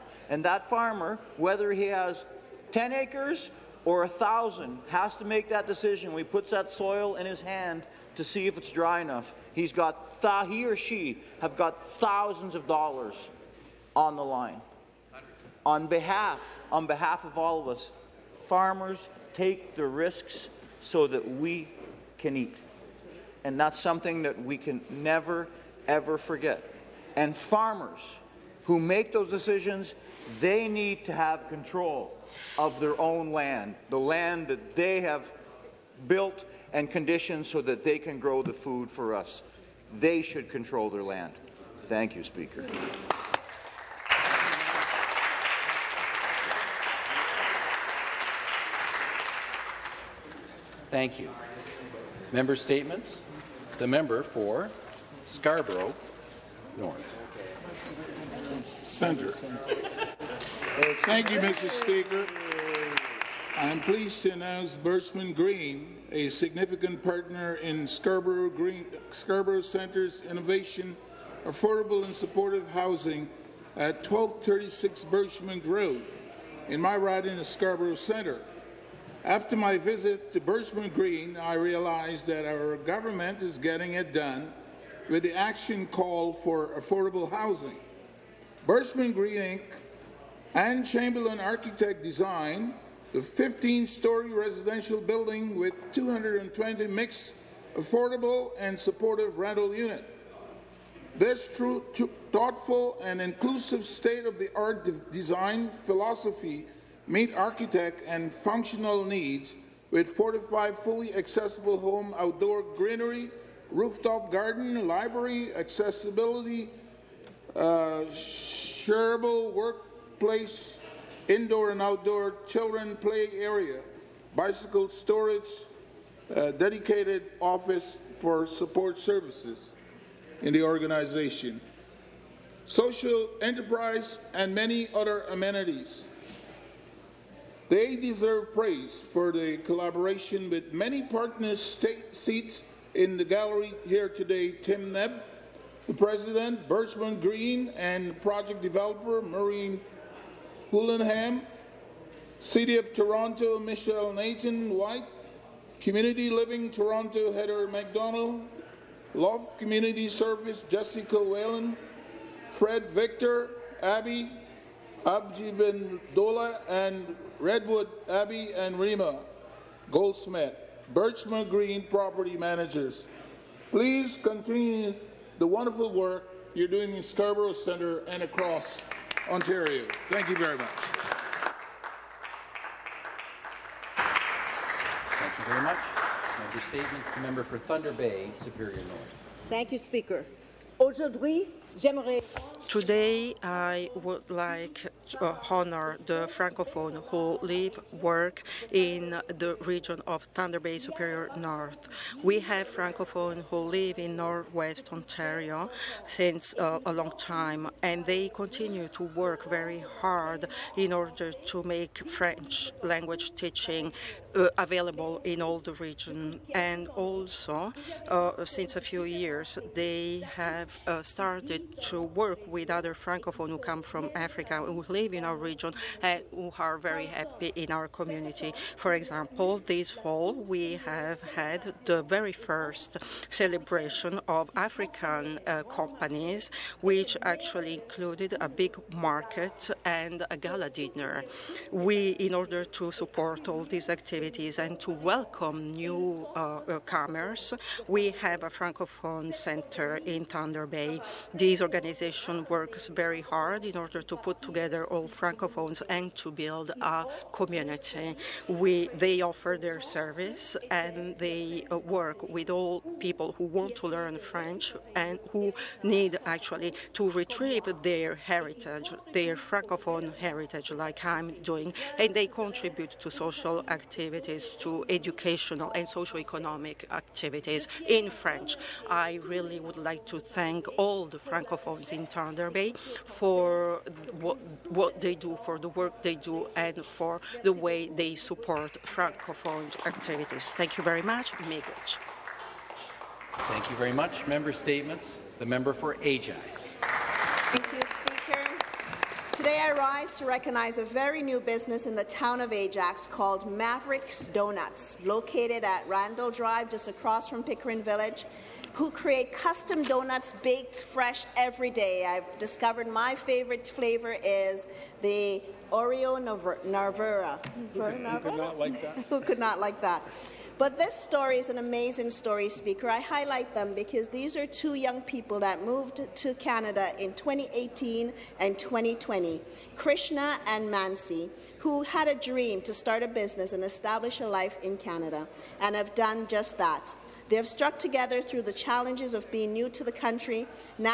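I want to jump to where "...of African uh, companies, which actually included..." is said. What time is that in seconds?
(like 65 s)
234 s.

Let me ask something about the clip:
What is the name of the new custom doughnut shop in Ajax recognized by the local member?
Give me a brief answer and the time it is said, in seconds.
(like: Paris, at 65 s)
Mavericks Donuts, at 303 s.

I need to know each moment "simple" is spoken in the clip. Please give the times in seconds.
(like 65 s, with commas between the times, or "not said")
not said.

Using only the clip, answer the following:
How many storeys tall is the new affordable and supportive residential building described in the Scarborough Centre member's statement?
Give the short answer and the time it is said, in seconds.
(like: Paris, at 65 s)
15, at 93 s.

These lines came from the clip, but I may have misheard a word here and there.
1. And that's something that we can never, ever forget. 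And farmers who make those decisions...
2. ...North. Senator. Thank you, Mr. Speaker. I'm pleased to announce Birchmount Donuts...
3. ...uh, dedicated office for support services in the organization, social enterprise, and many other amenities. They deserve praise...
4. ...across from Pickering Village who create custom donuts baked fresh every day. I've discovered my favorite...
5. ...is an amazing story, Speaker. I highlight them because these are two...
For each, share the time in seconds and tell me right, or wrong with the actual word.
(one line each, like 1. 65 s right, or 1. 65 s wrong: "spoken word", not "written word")
1. 23 s right
2. 56 s wrong: "Green", not "Donuts"
3. 126 s right
4. 306 s right
5. 321 s right.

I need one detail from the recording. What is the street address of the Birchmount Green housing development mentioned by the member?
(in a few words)
1236 Birchmount Road.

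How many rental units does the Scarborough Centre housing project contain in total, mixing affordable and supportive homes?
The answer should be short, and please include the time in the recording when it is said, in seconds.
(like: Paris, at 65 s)
220, at 95 s.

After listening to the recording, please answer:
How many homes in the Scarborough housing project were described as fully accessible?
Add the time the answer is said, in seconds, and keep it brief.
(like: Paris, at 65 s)
45, at 110 s.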